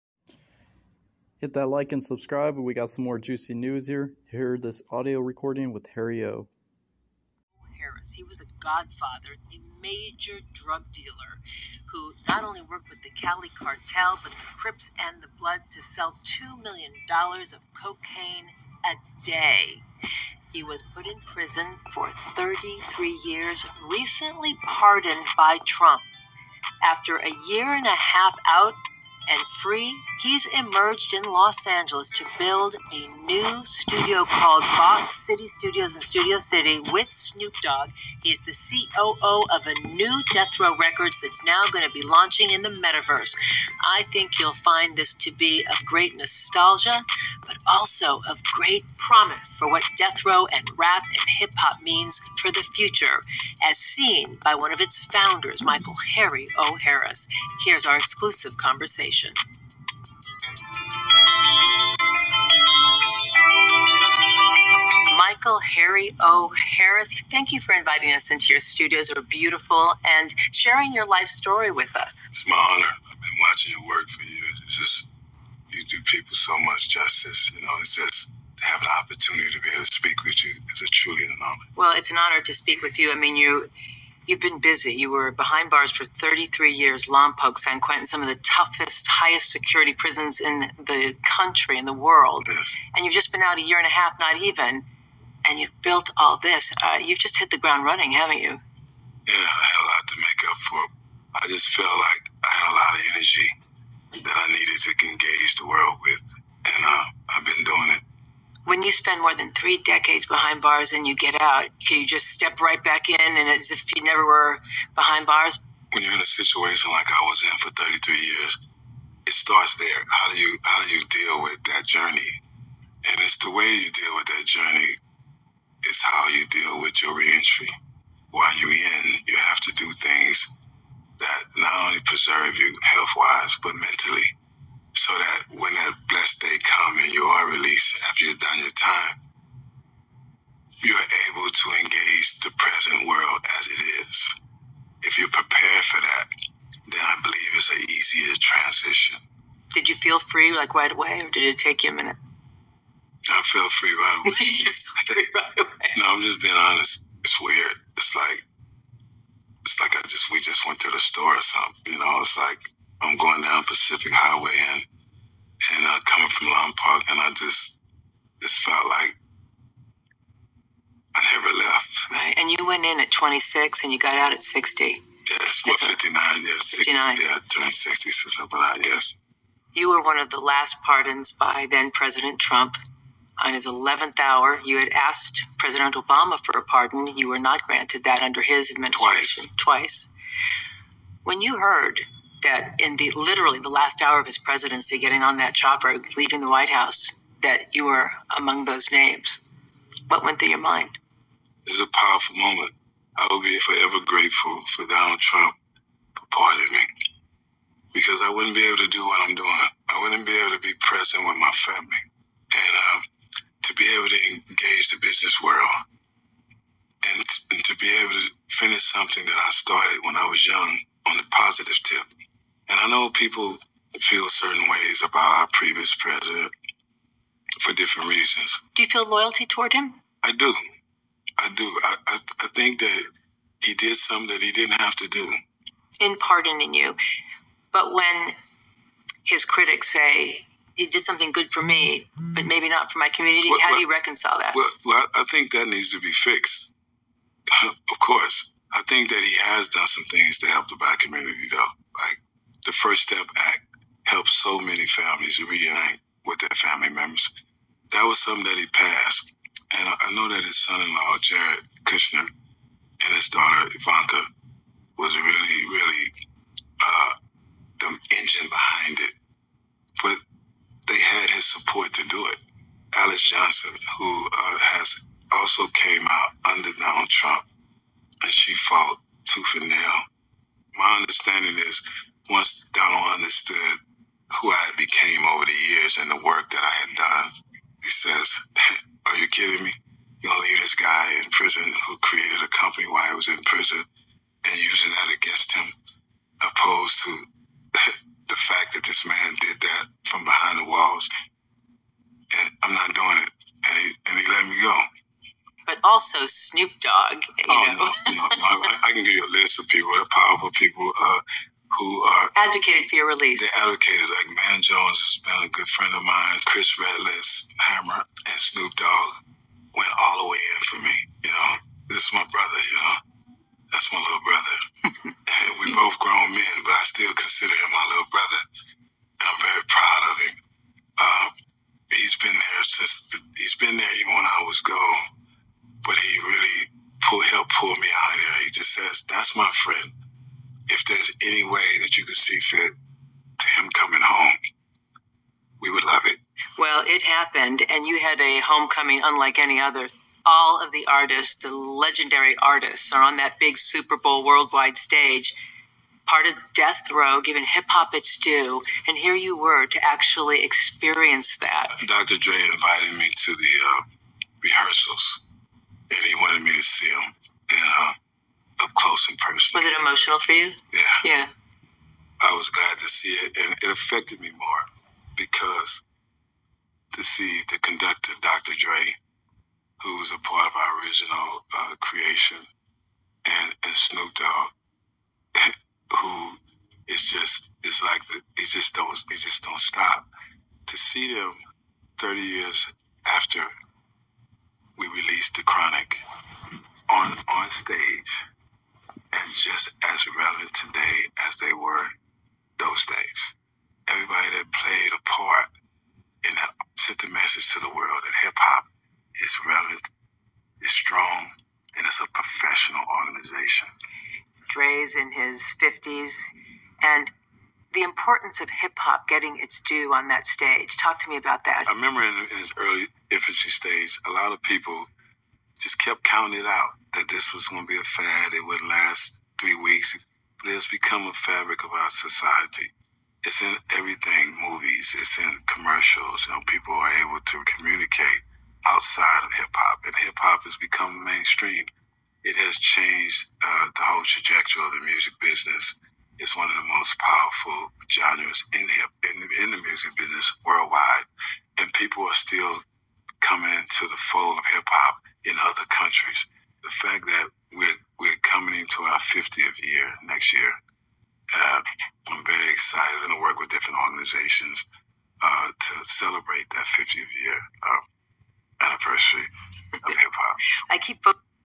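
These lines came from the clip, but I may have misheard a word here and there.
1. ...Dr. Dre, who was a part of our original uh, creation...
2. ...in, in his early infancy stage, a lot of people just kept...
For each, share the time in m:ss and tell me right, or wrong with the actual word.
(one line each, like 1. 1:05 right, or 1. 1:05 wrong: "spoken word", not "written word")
1. 6:18 right
2. 7:02 right.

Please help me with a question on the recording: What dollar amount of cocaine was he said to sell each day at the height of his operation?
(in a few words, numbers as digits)
$2 million.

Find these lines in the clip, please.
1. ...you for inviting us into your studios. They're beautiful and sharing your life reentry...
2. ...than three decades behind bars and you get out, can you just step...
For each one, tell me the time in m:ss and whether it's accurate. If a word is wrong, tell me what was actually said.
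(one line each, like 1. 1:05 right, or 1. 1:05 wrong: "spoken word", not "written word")
1. 1:07 wrong: "story", not "reentry"
2. 1:49 right.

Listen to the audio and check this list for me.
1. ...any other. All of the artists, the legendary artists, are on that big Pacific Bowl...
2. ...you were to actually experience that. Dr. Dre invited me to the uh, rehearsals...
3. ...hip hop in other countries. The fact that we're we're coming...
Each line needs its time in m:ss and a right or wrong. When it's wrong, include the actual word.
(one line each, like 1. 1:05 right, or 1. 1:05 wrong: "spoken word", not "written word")
1. 5:49 wrong: "Super", not "Pacific"
2. 5:59 right
3. 7:34 right.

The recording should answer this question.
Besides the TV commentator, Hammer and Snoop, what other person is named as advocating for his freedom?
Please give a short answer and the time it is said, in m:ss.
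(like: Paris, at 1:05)
Chris Redlitz, at 5:16.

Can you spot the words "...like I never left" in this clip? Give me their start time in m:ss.
2:48.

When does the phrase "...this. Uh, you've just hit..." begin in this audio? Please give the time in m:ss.
1:36.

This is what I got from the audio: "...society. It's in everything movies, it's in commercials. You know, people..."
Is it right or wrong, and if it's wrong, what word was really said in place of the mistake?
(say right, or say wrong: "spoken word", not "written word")
right.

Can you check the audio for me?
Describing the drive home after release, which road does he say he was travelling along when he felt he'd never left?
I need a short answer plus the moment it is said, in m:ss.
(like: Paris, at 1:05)
Pacific Highway, at 2:43.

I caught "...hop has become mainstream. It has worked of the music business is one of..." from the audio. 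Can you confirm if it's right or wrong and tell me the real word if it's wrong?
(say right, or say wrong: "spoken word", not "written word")
wrong: "changed", not "worked".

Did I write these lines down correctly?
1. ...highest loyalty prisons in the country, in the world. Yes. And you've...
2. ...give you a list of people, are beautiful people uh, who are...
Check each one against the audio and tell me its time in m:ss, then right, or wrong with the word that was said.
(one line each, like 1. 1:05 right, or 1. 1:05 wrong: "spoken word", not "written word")
1. 1:29 wrong: "security", not "loyalty"
2. 5:09 wrong: "powerful", not "beautiful".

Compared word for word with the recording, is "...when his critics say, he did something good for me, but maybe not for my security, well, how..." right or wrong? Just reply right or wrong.
wrong.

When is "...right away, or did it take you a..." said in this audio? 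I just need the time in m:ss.
2:30.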